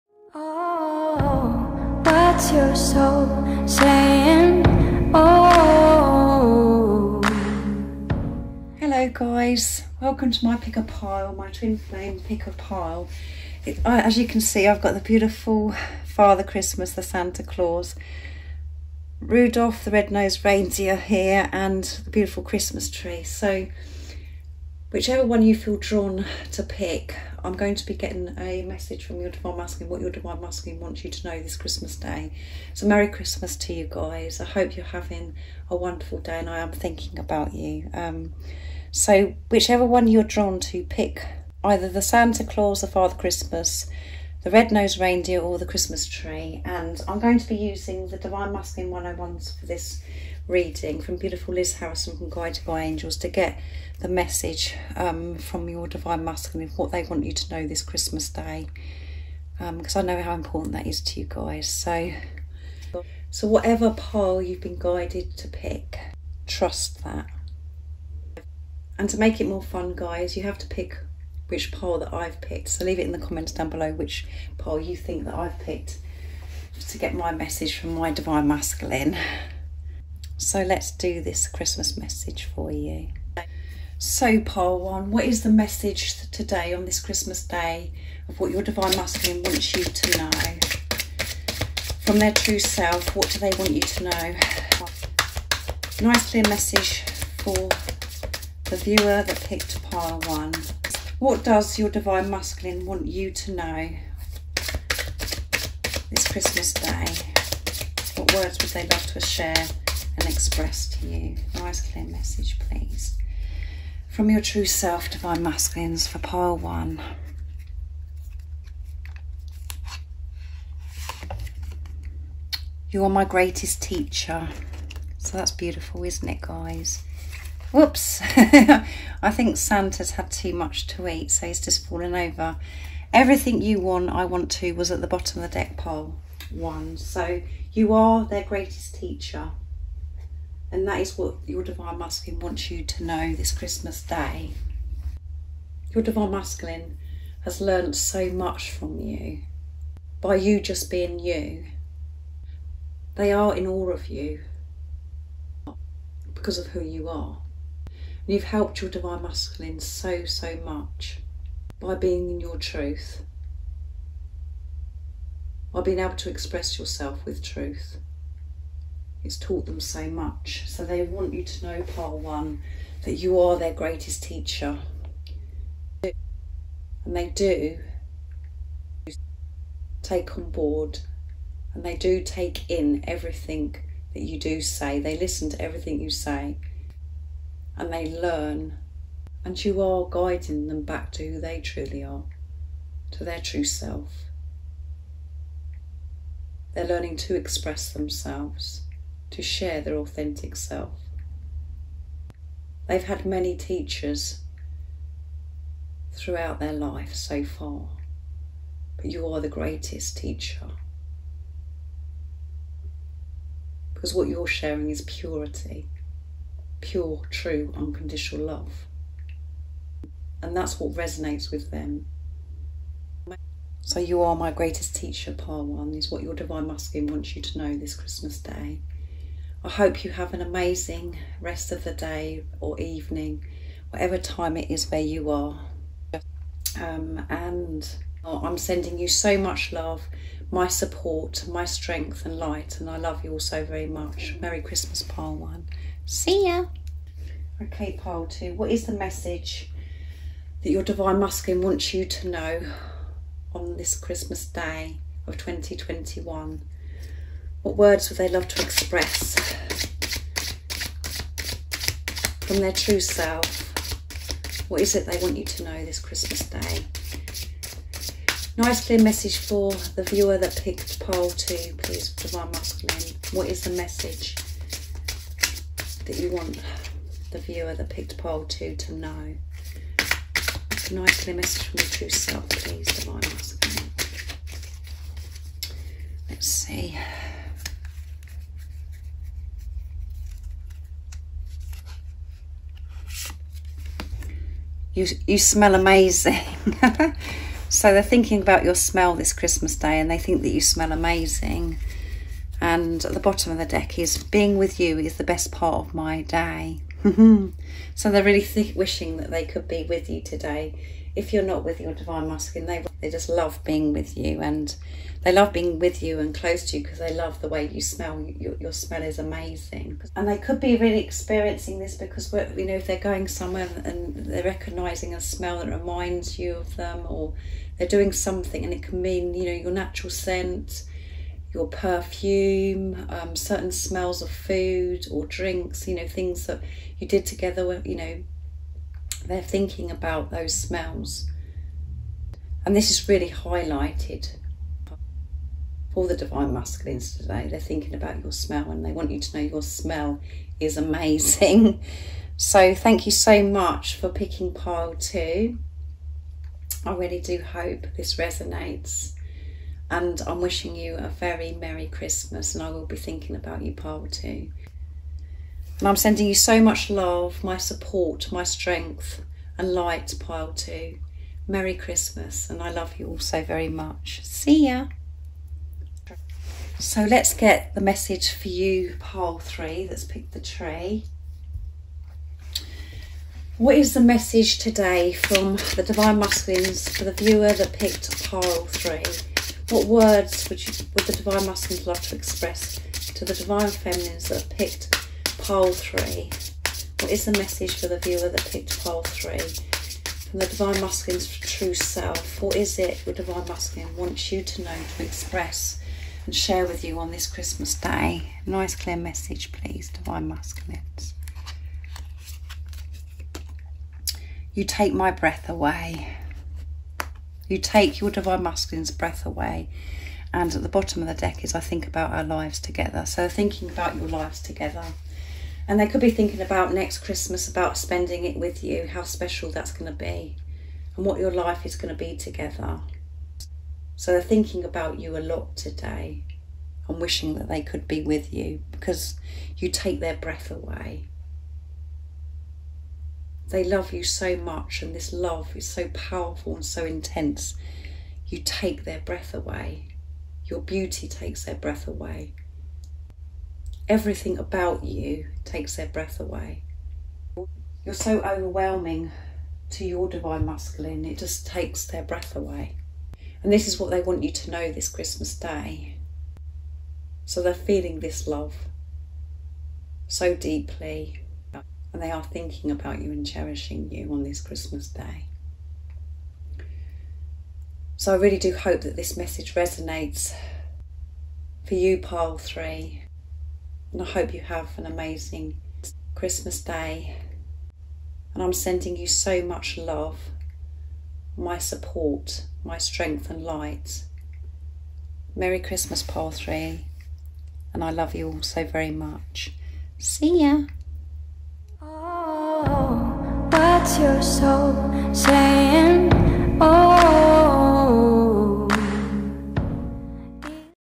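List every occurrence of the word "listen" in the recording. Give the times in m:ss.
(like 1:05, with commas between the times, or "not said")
3:05.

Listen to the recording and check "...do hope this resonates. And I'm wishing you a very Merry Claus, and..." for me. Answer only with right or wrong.
wrong.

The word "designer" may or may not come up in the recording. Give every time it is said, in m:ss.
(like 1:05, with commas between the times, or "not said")
not said.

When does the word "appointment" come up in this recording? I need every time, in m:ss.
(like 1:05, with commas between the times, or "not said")
not said.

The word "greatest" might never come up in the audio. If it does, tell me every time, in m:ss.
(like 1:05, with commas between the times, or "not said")
2:03, 2:18, 2:53, 3:29, 3:44.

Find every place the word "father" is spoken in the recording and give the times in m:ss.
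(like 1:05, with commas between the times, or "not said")
0:16, 0:42.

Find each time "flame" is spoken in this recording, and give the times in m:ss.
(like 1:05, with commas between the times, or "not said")
0:11.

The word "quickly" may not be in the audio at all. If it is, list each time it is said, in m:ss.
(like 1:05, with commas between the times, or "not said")
not said.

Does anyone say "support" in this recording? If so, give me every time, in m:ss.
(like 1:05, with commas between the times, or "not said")
4:00, 6:07, 8:11.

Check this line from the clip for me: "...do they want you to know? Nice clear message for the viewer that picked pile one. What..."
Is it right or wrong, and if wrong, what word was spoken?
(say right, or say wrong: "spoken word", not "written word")
right.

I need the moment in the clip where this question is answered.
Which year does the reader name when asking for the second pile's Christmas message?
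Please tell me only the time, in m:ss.
4:15.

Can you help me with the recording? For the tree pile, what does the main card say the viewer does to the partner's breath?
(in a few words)
Take my breath away.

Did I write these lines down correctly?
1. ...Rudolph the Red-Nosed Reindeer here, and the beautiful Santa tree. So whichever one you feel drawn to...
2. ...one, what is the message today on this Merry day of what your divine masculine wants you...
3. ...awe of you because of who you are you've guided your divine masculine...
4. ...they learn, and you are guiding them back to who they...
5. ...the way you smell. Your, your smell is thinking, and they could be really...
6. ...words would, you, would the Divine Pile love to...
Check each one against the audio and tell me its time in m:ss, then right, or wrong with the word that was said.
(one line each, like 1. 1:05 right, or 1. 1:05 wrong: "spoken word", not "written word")
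1. 0:19 wrong: "Christmas", not "Santa"
2. 1:24 wrong: "Christmas", not "Merry"
3. 2:33 wrong: "helped", not "guided"
4. 3:07 right
5. 5:17 wrong: "amazing", not "thinking"
6. 6:29 wrong: "Masculines", not "Pile".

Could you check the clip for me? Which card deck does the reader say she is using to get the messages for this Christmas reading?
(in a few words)
Divine Masculine 101s.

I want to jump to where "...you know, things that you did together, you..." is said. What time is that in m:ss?
5:35.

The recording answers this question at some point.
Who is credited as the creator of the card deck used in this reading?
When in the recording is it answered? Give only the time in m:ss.
0:51.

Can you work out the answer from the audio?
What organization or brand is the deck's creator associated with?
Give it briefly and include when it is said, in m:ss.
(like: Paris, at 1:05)
Guided by Angels, at 0:52.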